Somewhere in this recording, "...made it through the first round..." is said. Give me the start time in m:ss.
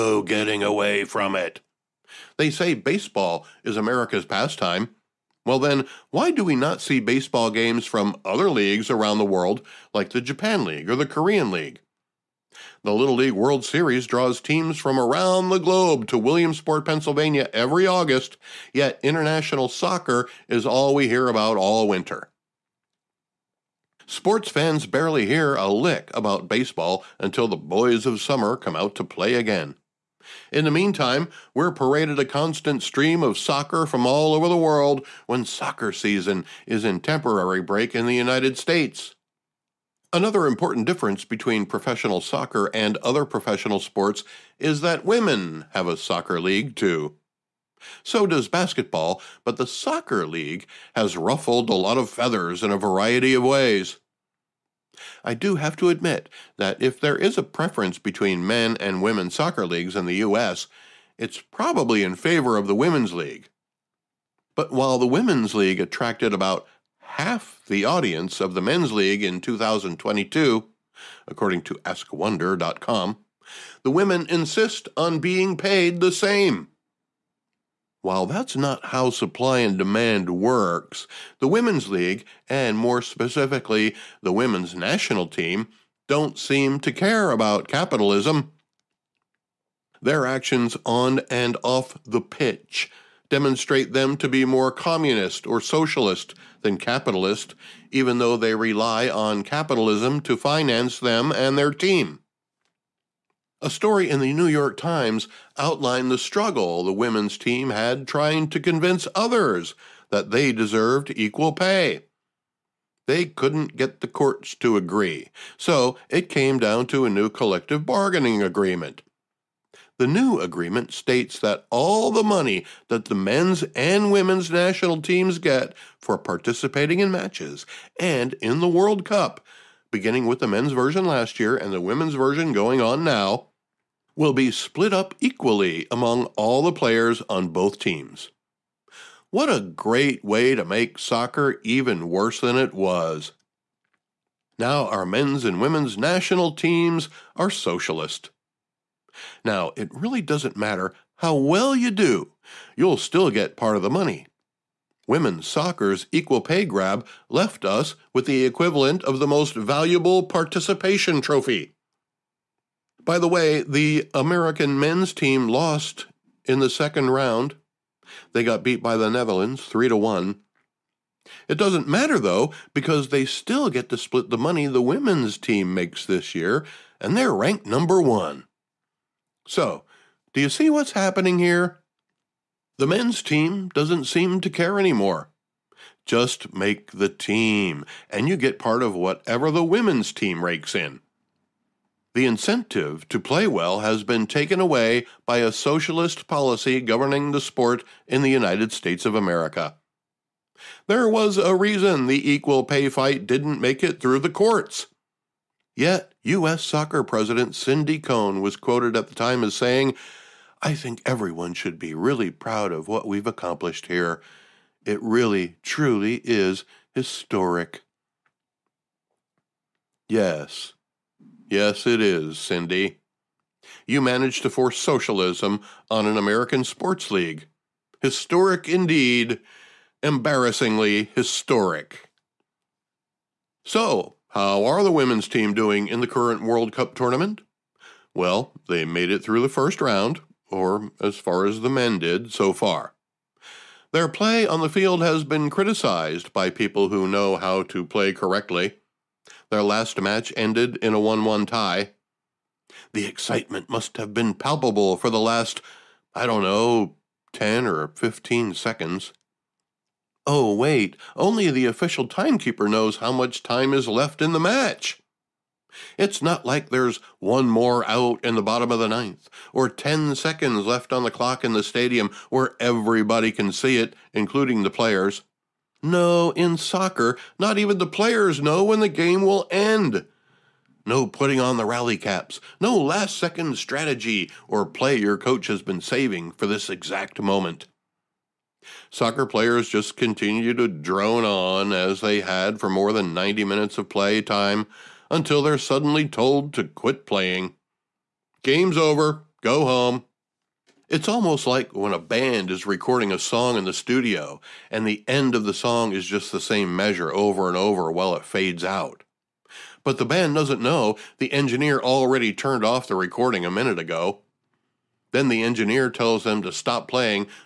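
3:58.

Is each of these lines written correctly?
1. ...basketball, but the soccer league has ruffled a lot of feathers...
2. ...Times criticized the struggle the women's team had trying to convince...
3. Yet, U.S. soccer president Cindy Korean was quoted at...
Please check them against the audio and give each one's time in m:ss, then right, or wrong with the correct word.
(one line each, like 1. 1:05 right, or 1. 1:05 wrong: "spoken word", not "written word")
1. 0:48 right
2. 1:44 wrong: "outlined", not "criticized"
3. 3:25 wrong: "Cone", not "Korean".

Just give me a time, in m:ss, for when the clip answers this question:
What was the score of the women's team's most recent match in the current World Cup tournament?
4:10.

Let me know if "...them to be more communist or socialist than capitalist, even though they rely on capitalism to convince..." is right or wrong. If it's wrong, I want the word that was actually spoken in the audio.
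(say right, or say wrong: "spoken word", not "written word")
wrong: "finance", not "convince".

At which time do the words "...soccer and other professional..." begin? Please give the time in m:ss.
0:42.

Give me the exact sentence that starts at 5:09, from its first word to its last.
But the band doesn't know the engineer already turned off the recording a minute ago.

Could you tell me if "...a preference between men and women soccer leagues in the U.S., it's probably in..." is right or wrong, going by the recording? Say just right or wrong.
right.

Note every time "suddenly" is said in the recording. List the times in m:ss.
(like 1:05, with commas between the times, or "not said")
4:55.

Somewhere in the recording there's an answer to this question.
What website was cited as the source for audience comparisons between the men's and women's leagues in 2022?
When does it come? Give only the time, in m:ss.
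1:11.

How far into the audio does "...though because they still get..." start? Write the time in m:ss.
2:52.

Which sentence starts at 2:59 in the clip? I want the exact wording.
So, do you see what's happening here?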